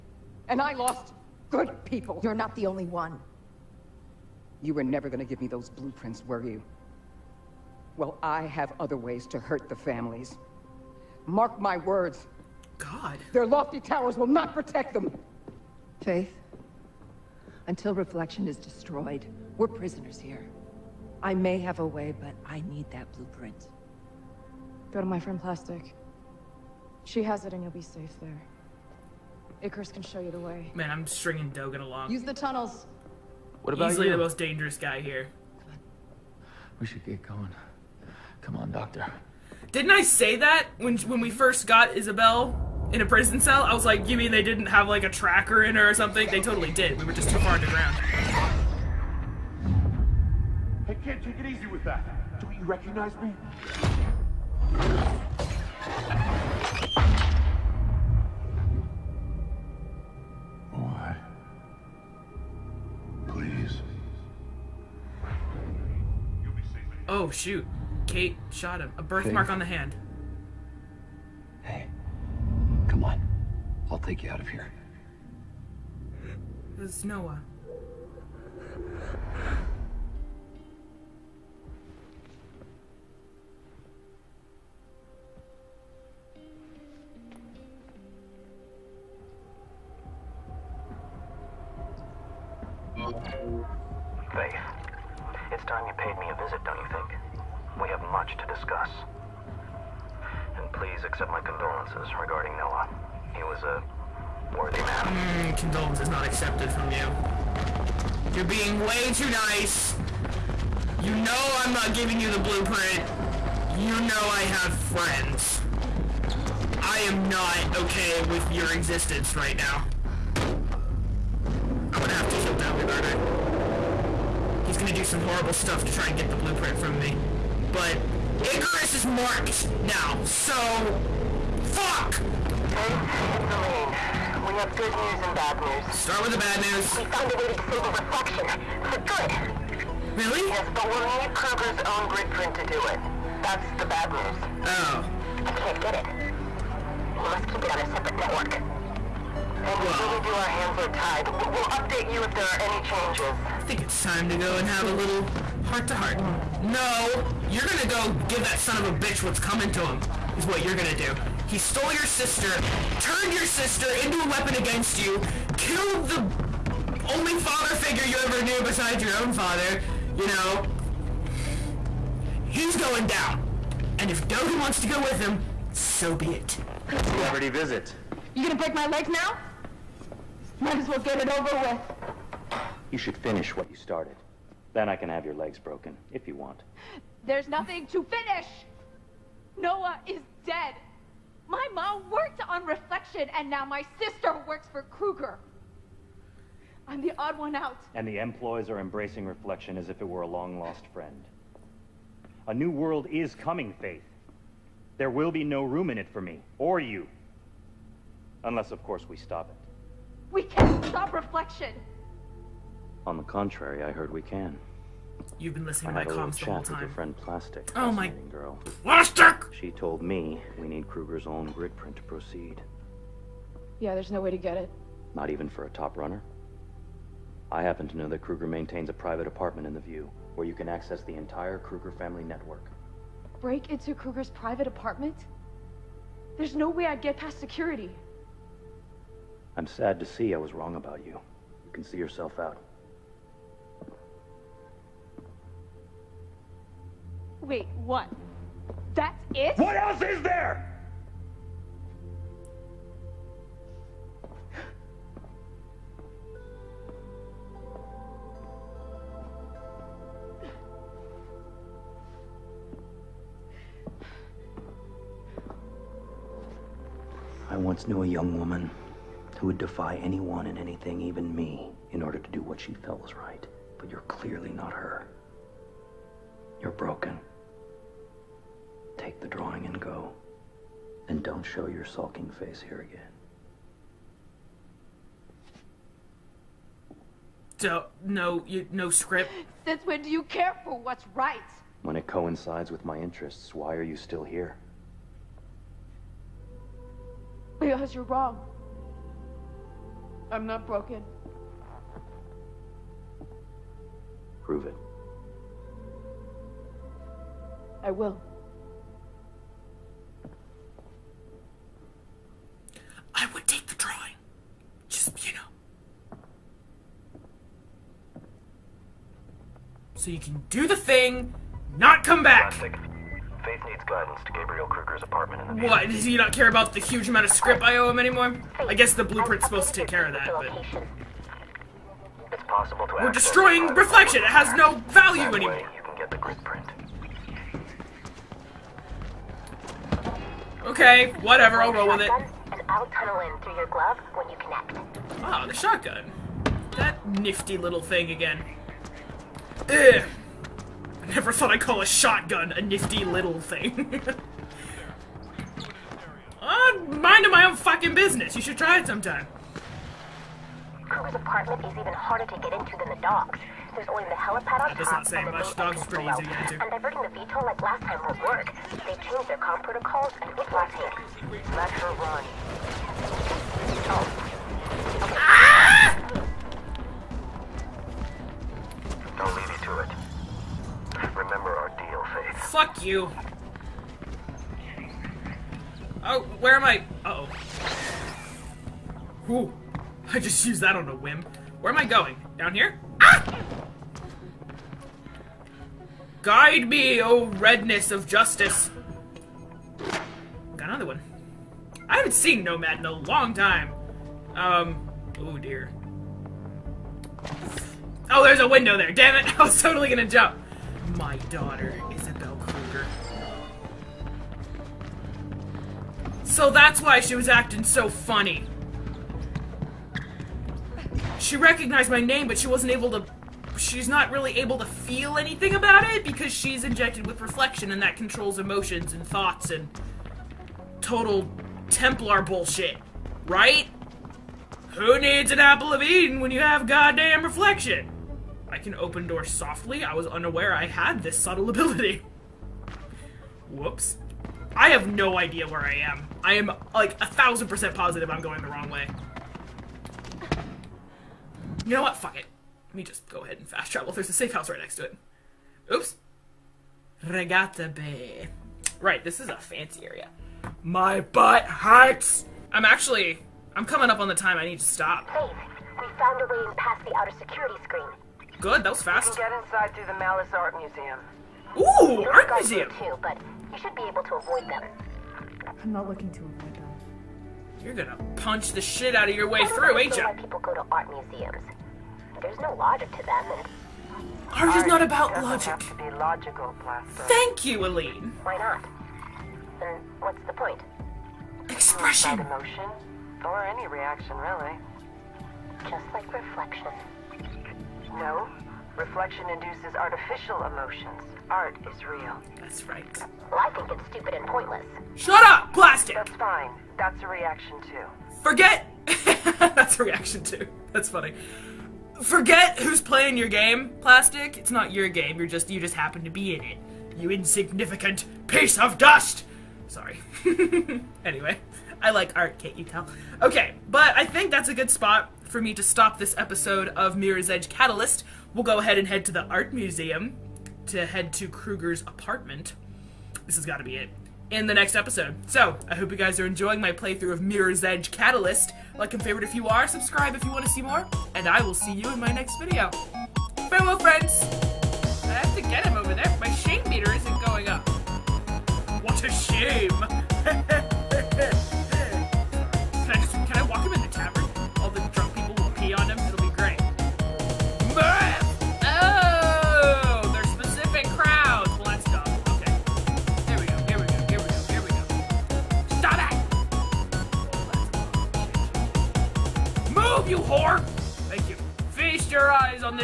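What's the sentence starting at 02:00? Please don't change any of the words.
I'm gonna have to kill David, aren't I?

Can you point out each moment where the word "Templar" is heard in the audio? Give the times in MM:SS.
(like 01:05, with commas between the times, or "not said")
07:11.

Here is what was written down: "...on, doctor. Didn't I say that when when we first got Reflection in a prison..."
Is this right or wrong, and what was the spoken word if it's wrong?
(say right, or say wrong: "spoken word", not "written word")
wrong: "Isabel", not "Reflection".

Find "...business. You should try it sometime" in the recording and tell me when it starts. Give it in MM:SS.
05:57.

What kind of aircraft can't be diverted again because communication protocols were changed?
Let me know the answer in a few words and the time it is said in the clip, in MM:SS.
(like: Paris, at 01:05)
VTOL, at 06:07.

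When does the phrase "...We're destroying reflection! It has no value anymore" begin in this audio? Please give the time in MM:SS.
05:33.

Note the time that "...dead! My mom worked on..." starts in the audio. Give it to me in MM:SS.
03:10.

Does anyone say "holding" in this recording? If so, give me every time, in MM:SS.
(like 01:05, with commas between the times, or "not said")
not said.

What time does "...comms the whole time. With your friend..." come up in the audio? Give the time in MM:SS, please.
03:36.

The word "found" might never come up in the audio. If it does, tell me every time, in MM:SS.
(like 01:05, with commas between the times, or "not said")
02:17, 07:45.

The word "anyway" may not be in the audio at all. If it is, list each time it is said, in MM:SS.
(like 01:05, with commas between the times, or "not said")
08:41.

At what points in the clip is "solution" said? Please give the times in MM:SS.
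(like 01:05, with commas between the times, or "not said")
not said.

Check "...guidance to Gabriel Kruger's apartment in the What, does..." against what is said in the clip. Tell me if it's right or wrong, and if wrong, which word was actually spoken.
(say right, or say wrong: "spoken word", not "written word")
right.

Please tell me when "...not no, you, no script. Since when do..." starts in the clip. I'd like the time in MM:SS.
04:47.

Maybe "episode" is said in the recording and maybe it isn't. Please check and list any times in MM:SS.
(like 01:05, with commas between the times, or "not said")
08:46, 08:54.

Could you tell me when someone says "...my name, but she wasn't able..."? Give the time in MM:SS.
07:01.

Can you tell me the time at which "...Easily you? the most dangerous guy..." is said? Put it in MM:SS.
00:33.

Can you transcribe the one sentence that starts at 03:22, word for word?
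A new world is coming, Faith.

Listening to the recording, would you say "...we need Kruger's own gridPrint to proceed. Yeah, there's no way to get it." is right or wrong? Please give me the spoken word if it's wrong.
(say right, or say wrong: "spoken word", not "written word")
right.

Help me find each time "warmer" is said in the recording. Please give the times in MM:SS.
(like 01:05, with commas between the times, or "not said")
not said.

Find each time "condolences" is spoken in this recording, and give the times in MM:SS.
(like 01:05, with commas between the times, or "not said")
01:41, 01:45.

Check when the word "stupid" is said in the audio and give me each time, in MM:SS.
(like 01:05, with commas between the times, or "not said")
08:23.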